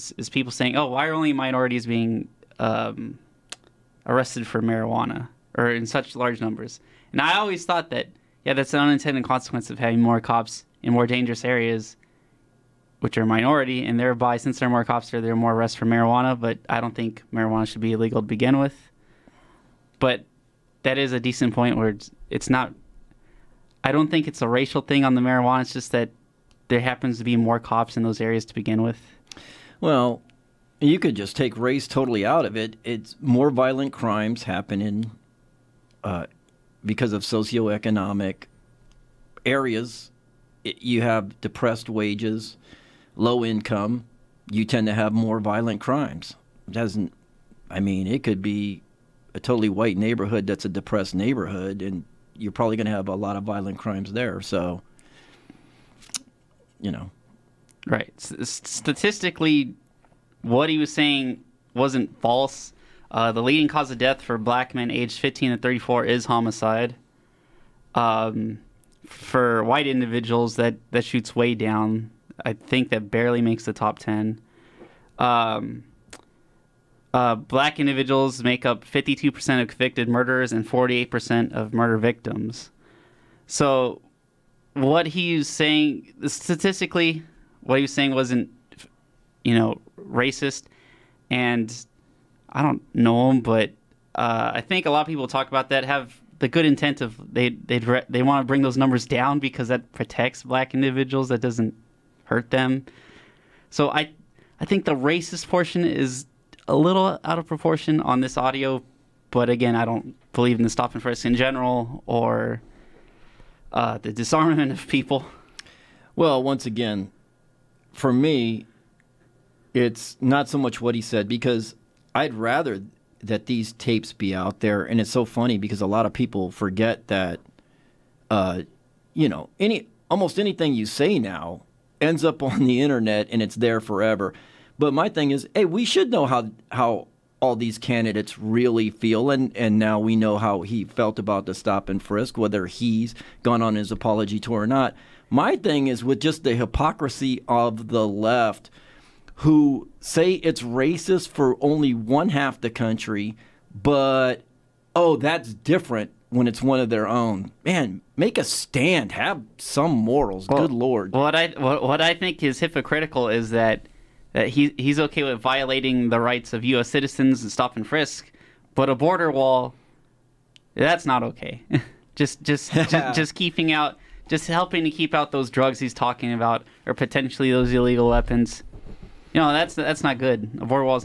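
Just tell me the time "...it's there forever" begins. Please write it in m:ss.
2:13.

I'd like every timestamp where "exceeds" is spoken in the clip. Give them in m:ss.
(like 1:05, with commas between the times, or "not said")
not said.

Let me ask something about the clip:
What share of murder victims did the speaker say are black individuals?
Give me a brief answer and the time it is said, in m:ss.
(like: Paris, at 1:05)
48%, at 1:20.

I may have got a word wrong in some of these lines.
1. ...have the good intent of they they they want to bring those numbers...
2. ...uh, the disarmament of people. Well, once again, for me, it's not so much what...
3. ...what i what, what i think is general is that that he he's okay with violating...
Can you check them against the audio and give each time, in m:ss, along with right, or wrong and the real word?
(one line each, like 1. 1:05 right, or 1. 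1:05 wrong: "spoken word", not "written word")
1. 1:35 right
2. 1:53 right
3. 2:41 wrong: "hypocritical", not "general".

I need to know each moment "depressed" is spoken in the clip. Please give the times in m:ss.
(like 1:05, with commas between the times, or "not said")
0:41, 0:50.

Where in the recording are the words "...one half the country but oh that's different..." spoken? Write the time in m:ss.
2:31.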